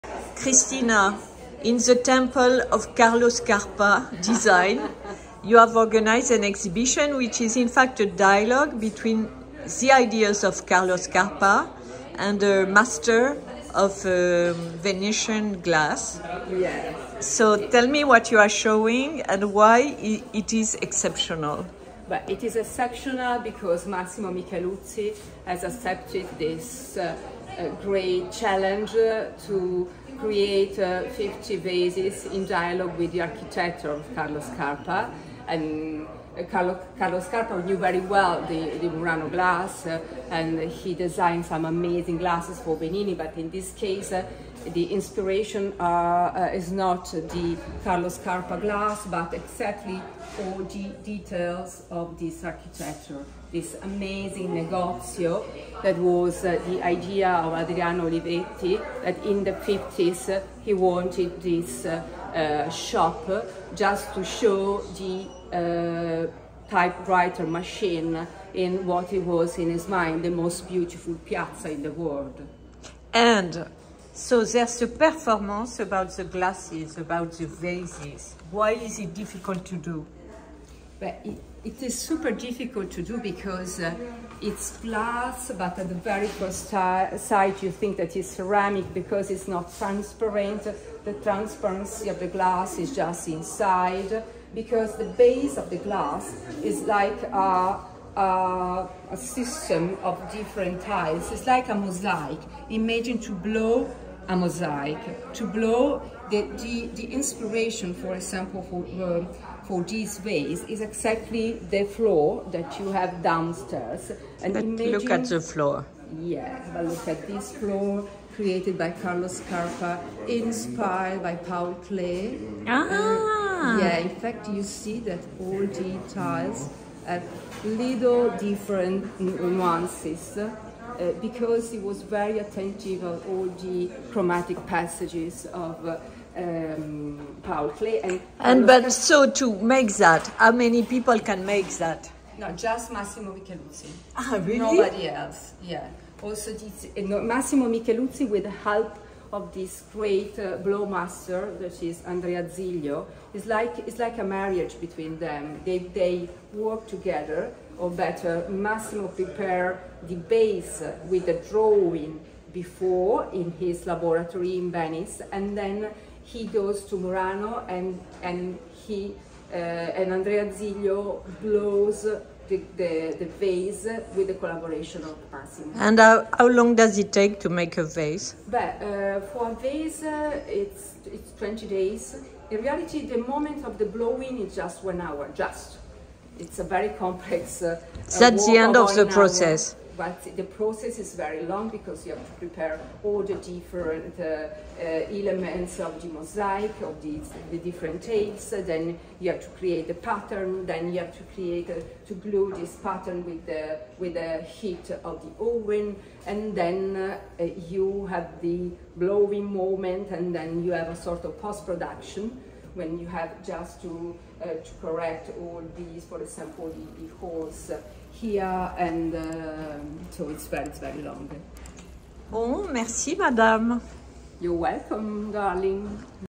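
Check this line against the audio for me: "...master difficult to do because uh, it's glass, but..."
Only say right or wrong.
wrong.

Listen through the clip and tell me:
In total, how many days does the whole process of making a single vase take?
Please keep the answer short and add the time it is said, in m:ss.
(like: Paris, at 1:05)
20 days, at 3:01.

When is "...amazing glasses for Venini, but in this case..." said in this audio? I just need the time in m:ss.
0:41.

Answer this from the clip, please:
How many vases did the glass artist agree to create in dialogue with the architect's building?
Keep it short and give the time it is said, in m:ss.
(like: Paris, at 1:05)
50, at 0:31.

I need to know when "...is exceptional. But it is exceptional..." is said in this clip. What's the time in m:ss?
0:20.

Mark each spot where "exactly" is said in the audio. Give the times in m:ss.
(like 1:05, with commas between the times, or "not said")
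0:49, 1:50.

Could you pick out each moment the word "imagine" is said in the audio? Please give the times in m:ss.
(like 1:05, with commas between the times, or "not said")
1:42, 1:54.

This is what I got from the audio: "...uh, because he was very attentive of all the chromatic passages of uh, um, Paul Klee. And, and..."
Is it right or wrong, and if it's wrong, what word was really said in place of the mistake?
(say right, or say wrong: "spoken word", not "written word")
right.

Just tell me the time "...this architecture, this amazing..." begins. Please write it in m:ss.
0:52.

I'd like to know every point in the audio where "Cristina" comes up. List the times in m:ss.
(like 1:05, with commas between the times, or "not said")
0:00.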